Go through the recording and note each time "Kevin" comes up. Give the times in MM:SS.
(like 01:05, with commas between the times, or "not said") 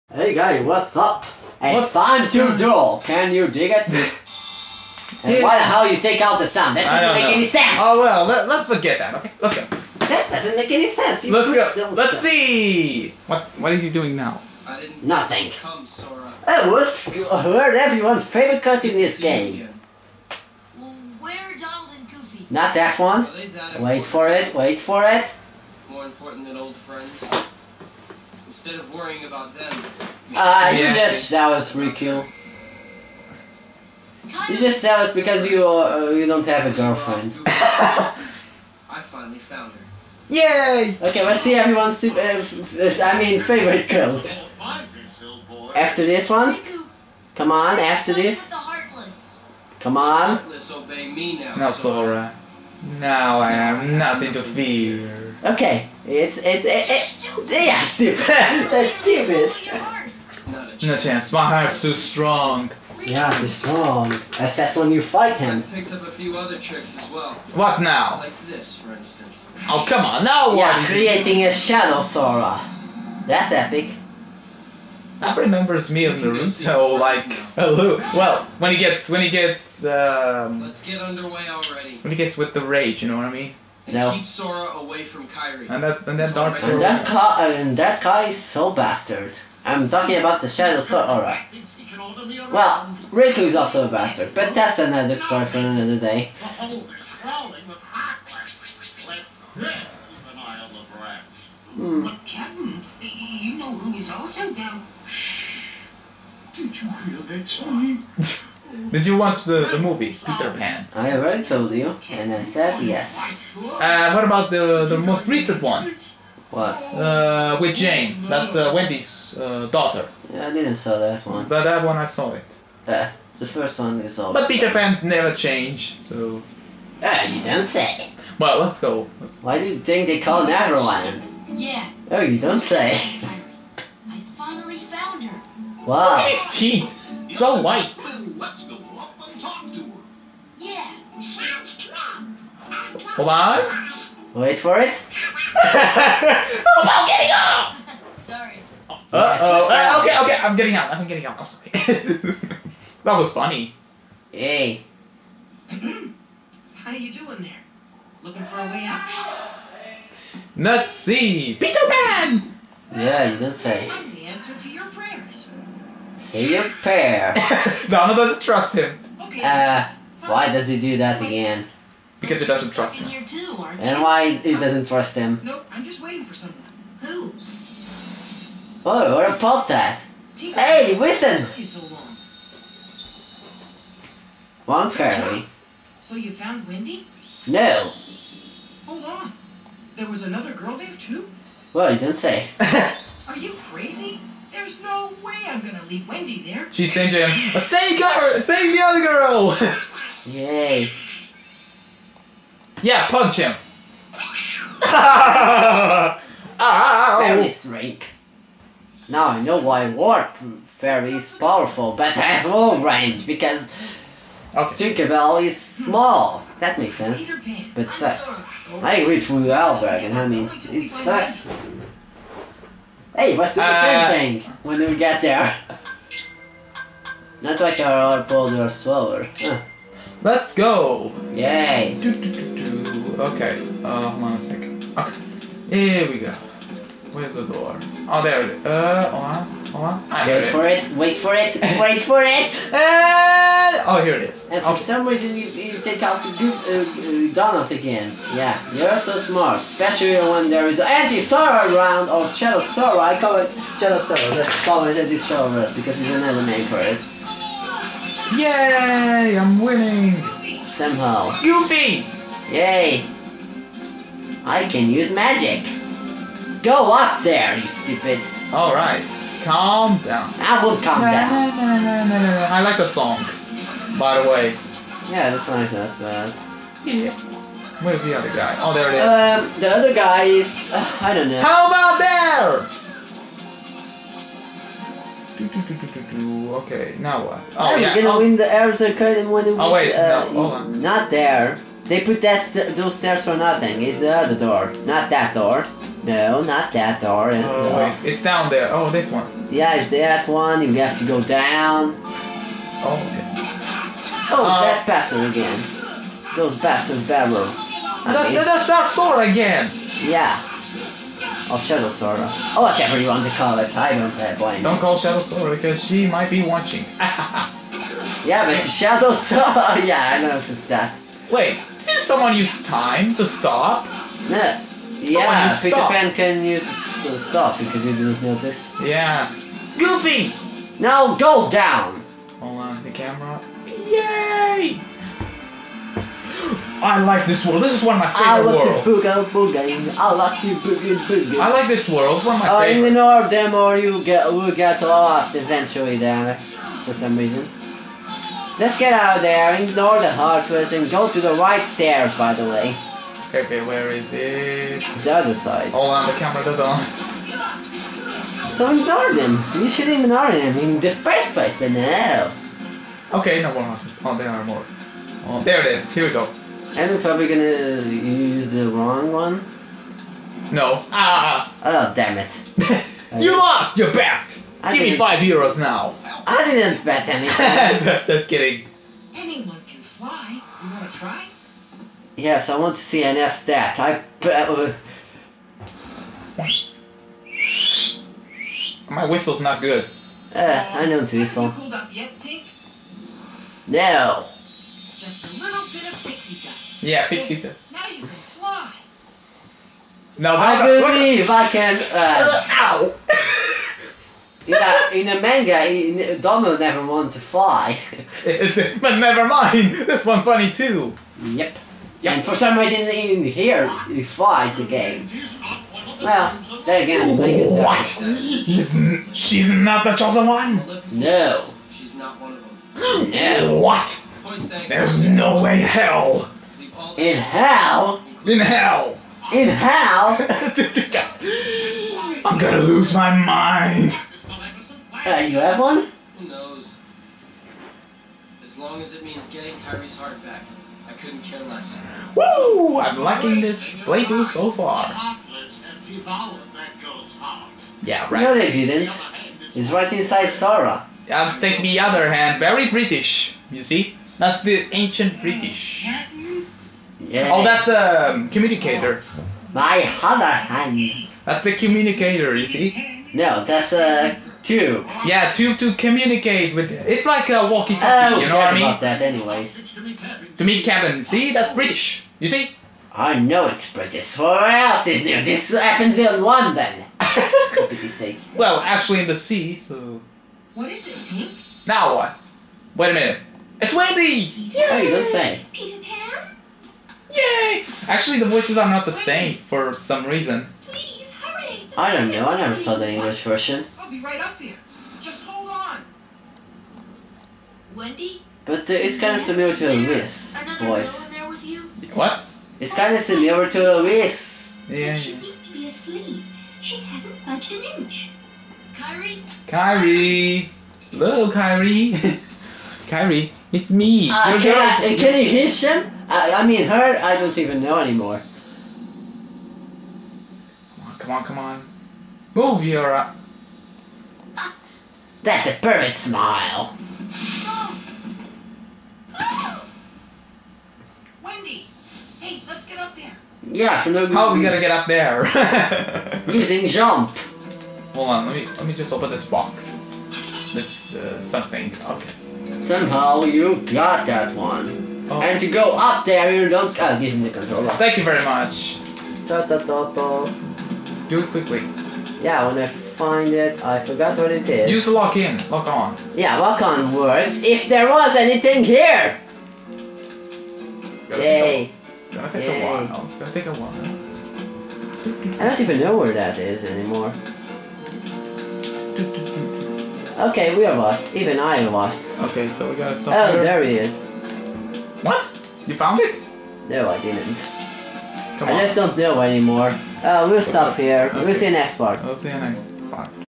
07:50.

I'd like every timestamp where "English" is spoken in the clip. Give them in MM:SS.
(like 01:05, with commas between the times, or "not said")
08:12.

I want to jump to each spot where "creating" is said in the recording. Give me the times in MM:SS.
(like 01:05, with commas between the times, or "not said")
01:10.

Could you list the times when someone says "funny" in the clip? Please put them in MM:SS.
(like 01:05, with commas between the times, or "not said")
02:33, 06:50.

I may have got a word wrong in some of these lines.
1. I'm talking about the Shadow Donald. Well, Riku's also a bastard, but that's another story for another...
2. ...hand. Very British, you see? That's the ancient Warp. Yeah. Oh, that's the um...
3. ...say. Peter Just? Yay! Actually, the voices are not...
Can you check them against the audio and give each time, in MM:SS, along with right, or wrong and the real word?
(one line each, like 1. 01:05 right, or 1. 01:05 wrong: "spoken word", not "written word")
1. 01:29 wrong: "Sora", not "Donald"
2. 07:32 wrong: "British", not "Warp"
3. 08:05 wrong: "Pan", not "Just".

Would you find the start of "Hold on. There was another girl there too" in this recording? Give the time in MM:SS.
03:08.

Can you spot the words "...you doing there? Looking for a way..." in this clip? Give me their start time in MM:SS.
02:36.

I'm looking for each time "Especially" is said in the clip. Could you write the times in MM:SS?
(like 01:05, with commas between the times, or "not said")
04:09.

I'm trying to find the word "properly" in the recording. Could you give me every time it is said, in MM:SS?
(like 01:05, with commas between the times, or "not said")
not said.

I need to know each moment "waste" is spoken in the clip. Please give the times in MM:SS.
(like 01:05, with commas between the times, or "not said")
not said.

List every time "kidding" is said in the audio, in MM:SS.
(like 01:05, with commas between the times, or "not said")
06:18.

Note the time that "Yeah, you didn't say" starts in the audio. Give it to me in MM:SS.
02:42.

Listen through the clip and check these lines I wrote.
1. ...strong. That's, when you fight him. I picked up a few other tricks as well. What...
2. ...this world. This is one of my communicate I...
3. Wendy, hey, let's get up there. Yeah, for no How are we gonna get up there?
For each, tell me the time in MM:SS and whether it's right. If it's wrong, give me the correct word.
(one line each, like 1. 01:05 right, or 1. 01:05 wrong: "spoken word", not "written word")
1. 01:03 right
2. 05:37 wrong: "favorite", not "communicate"
3. 08:51 right.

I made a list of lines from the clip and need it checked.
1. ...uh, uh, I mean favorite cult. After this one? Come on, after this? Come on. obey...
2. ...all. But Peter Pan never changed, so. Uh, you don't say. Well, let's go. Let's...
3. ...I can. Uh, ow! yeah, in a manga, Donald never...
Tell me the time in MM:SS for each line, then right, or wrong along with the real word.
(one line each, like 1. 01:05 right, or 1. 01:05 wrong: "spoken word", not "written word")
1. 00:42 right
2. 02:04 right
3. 06:41 right.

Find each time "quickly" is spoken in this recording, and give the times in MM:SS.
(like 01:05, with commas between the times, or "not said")
09:11.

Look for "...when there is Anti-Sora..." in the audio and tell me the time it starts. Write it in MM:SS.
04:10.